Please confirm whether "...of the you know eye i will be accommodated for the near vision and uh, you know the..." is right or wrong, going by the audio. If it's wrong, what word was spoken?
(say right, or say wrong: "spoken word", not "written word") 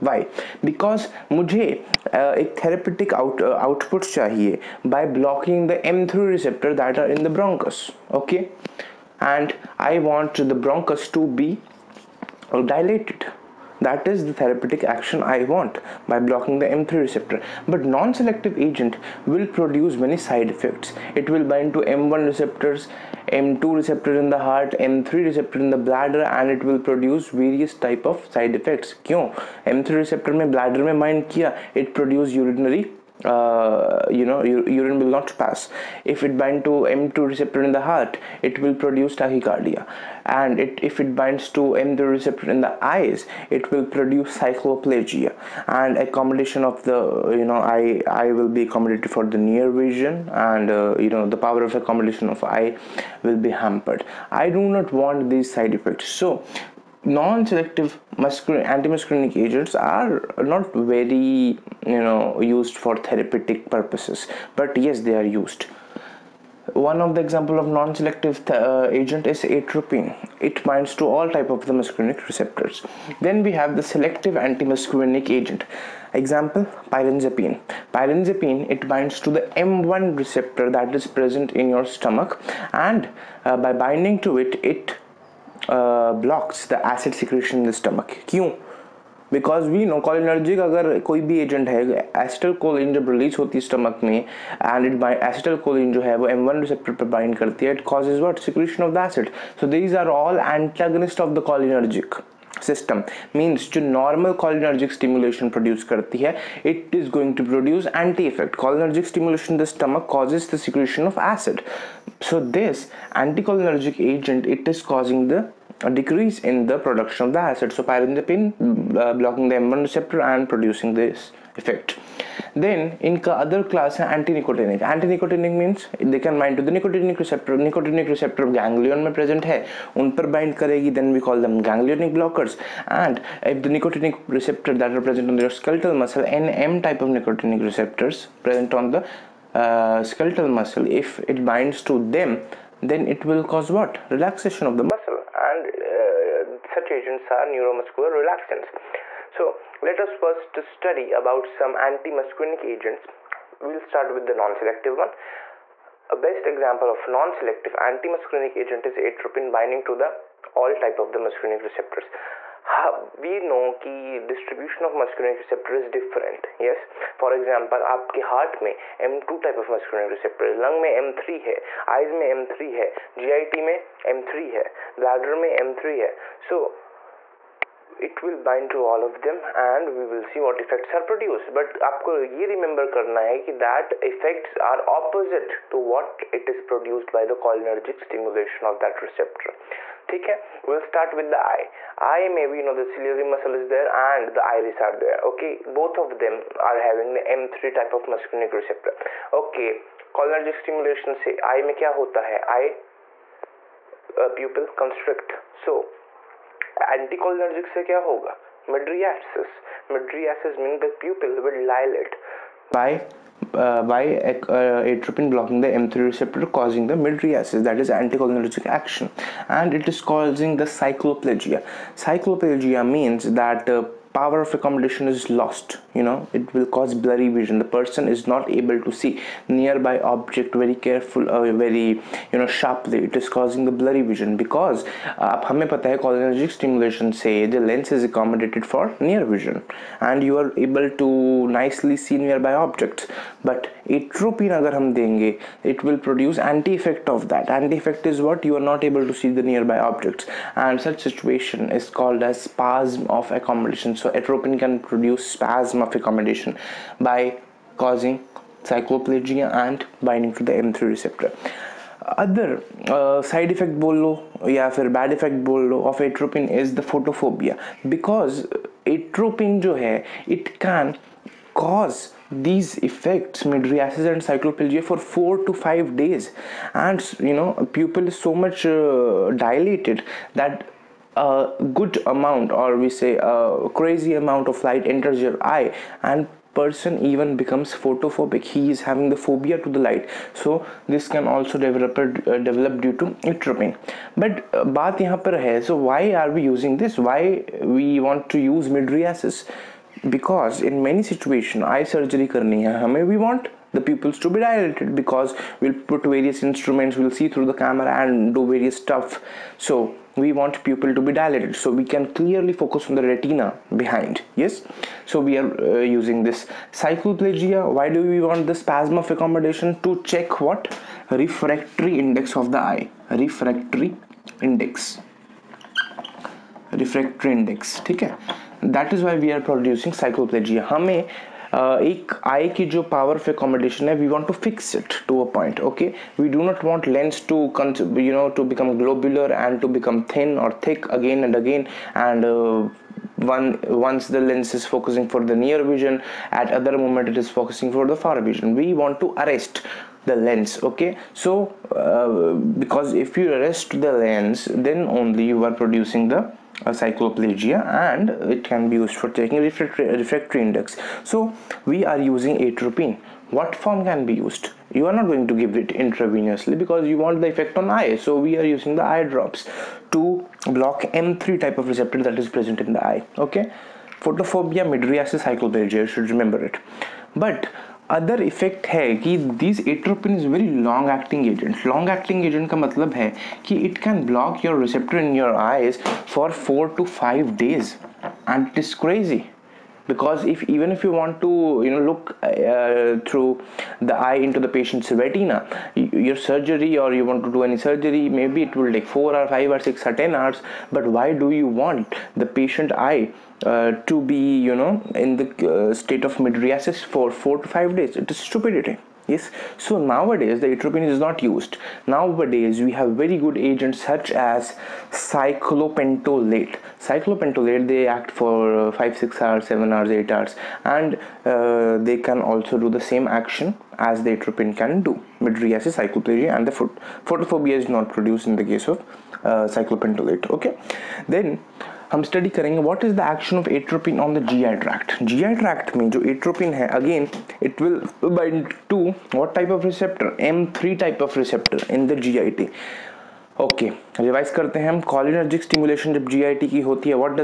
right.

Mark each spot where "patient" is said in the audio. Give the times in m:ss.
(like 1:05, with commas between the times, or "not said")
6:34, 6:42.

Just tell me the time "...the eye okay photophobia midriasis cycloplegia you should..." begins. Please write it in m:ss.
6:12.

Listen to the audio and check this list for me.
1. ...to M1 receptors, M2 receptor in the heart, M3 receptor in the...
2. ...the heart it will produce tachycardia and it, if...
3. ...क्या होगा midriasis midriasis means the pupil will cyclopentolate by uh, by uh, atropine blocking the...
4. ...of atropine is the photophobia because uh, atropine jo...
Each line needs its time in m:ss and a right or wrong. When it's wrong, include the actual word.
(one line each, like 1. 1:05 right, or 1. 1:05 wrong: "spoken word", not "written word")
1. 0:21 right
2. 0:37 right
3. 3:27 wrong: "dilate", not "cyclopentolate"
4. 4:25 right.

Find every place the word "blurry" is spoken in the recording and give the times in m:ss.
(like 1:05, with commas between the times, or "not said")
3:46, 3:53.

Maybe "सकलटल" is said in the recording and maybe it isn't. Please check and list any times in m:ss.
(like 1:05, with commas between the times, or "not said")
2:15, 2:20.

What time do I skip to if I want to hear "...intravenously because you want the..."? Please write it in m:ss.
6:05.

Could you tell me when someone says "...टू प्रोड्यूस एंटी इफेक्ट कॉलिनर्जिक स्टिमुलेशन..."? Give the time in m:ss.
1:47.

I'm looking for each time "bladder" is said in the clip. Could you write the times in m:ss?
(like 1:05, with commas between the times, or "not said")
0:25, 0:30.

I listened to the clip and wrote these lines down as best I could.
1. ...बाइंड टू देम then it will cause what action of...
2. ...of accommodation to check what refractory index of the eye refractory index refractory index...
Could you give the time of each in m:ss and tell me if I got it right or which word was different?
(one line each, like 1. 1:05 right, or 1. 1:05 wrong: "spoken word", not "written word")
1. 2:21 wrong: "relaxation", not "action"
2. 5:18 right.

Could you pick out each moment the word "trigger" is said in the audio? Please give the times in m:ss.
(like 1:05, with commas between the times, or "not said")
not said.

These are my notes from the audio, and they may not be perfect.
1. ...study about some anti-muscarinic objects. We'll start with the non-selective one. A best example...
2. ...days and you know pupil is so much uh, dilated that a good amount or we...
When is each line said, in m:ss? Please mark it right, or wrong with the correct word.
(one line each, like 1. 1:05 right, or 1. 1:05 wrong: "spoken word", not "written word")
1. 2:30 wrong: "agents", not "objects"
2. 4:36 right.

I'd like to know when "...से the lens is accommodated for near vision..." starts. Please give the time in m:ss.
3:57.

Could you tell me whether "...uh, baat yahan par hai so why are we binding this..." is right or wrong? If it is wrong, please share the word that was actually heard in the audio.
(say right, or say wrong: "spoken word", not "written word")
wrong: "using", not "binding".